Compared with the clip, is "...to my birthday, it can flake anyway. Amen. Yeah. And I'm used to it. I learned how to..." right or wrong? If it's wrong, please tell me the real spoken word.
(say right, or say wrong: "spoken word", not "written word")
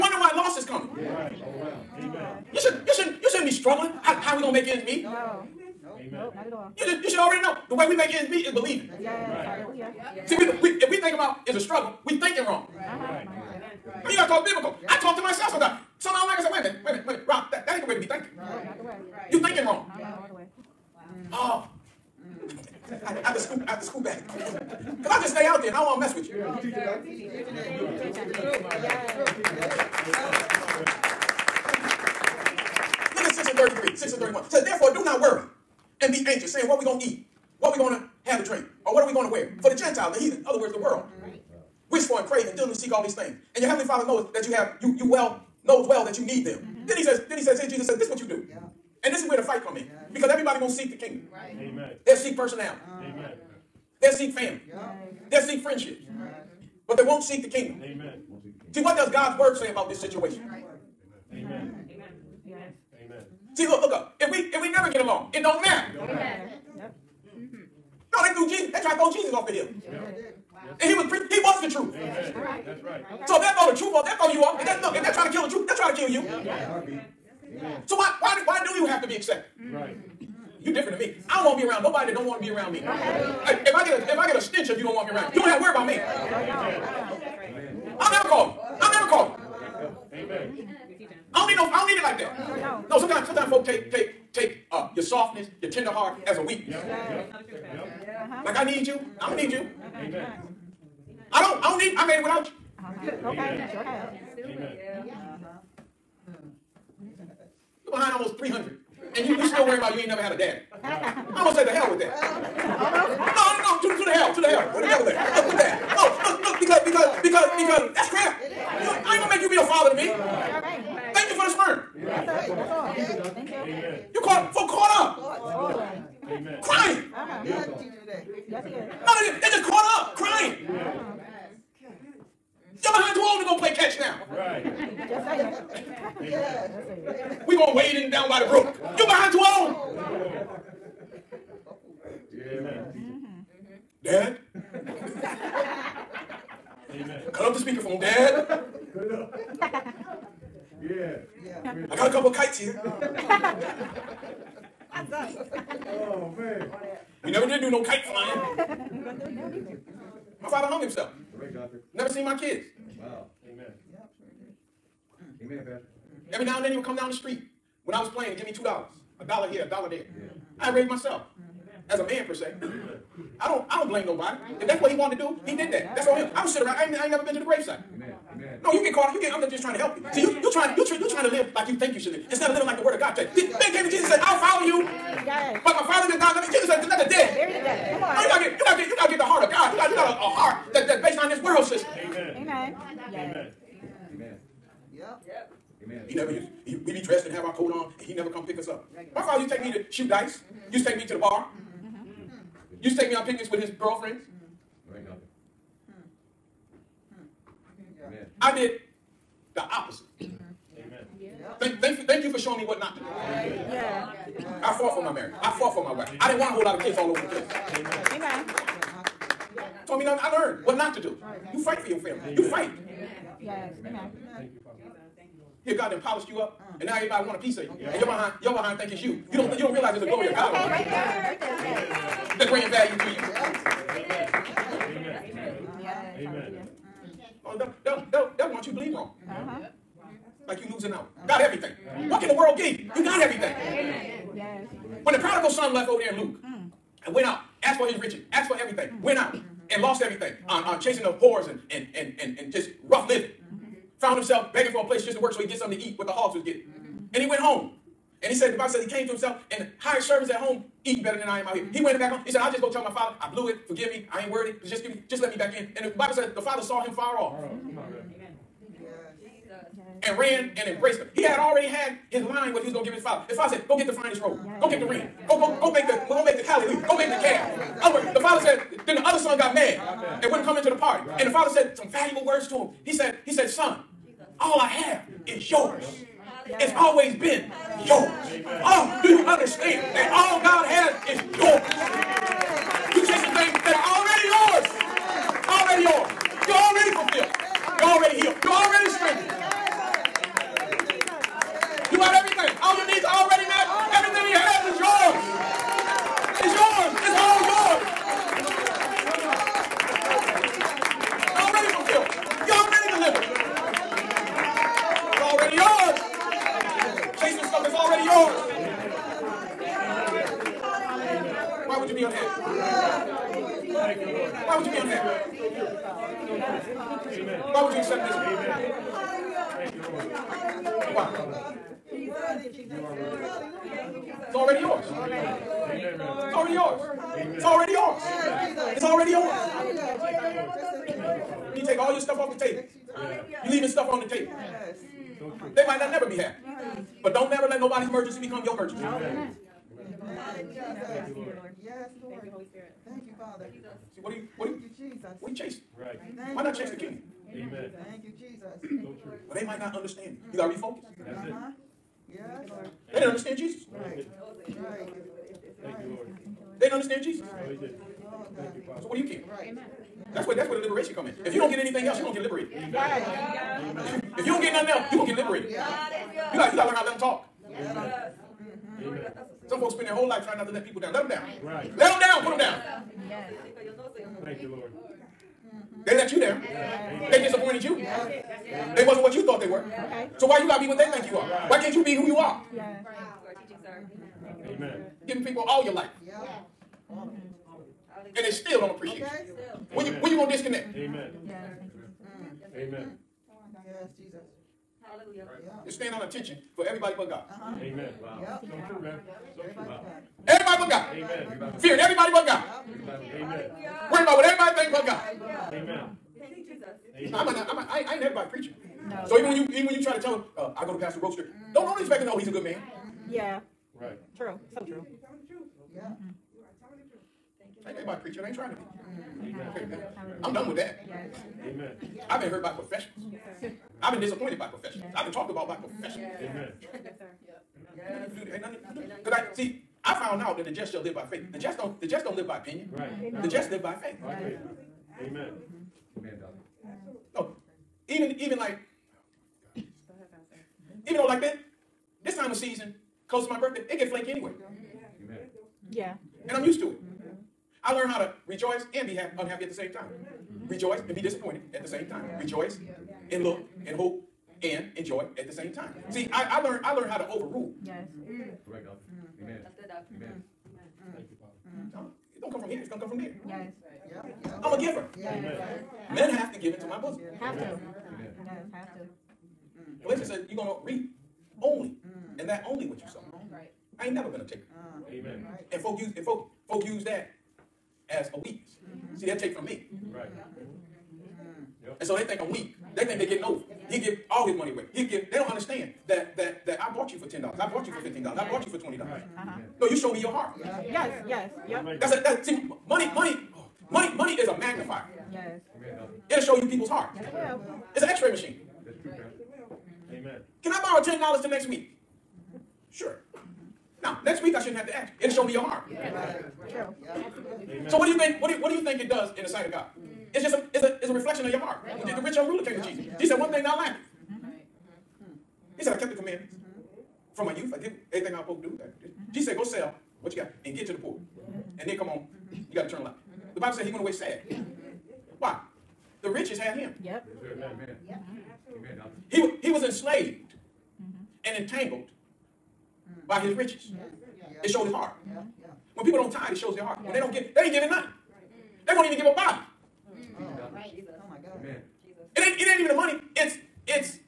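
right.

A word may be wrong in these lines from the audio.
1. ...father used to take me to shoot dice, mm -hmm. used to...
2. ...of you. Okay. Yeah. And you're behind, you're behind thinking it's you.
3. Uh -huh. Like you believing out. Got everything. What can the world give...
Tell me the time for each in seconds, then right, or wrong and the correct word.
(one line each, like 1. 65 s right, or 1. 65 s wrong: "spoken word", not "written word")
1. 199 s right
2. 227 s right
3. 239 s wrong: "losing", not "believing".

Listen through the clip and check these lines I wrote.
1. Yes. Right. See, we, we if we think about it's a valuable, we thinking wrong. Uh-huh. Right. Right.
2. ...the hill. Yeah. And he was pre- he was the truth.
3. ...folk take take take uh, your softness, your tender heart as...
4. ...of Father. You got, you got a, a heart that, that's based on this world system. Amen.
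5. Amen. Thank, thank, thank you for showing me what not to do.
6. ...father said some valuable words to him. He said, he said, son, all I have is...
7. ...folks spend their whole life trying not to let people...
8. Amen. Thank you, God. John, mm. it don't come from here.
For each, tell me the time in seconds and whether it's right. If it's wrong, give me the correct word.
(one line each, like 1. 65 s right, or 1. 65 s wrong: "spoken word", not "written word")
1. 9 s wrong: "struggle", not "valuable"
2. 69 s right
3. 93 s right
4. 189 s wrong: "God", not "Father"
5. 210 s right
6. 281 s right
7. 379 s right
8. 470 s wrong: "Father", not "God".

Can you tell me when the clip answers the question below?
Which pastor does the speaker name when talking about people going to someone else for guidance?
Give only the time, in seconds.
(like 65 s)
420 s.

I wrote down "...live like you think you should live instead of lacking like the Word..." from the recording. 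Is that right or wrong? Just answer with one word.
wrong.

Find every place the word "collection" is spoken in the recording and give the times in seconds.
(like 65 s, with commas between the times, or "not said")
not said.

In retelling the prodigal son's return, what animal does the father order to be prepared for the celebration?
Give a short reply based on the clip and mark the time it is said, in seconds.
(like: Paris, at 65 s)
The calf, at 277 s.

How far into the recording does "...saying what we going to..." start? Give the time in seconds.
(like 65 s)
36 s.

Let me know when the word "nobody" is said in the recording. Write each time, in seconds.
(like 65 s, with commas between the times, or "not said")
81 s, 174 s, 427 s.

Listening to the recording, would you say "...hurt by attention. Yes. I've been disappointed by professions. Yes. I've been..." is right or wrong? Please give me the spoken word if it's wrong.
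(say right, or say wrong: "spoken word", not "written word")
wrong: "profession", not "attention".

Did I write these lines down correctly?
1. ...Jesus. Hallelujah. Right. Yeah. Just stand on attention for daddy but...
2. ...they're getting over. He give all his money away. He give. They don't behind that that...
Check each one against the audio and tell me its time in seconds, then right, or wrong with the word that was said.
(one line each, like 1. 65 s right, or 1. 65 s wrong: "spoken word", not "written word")
1. 403 s wrong: "everybody", not "daddy"
2. 492 s wrong: "understand", not "behind".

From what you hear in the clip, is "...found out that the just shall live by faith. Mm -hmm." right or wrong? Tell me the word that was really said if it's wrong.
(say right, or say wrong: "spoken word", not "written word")
right.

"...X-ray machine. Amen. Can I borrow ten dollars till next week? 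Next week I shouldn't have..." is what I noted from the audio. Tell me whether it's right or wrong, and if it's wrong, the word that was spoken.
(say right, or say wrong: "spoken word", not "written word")
right.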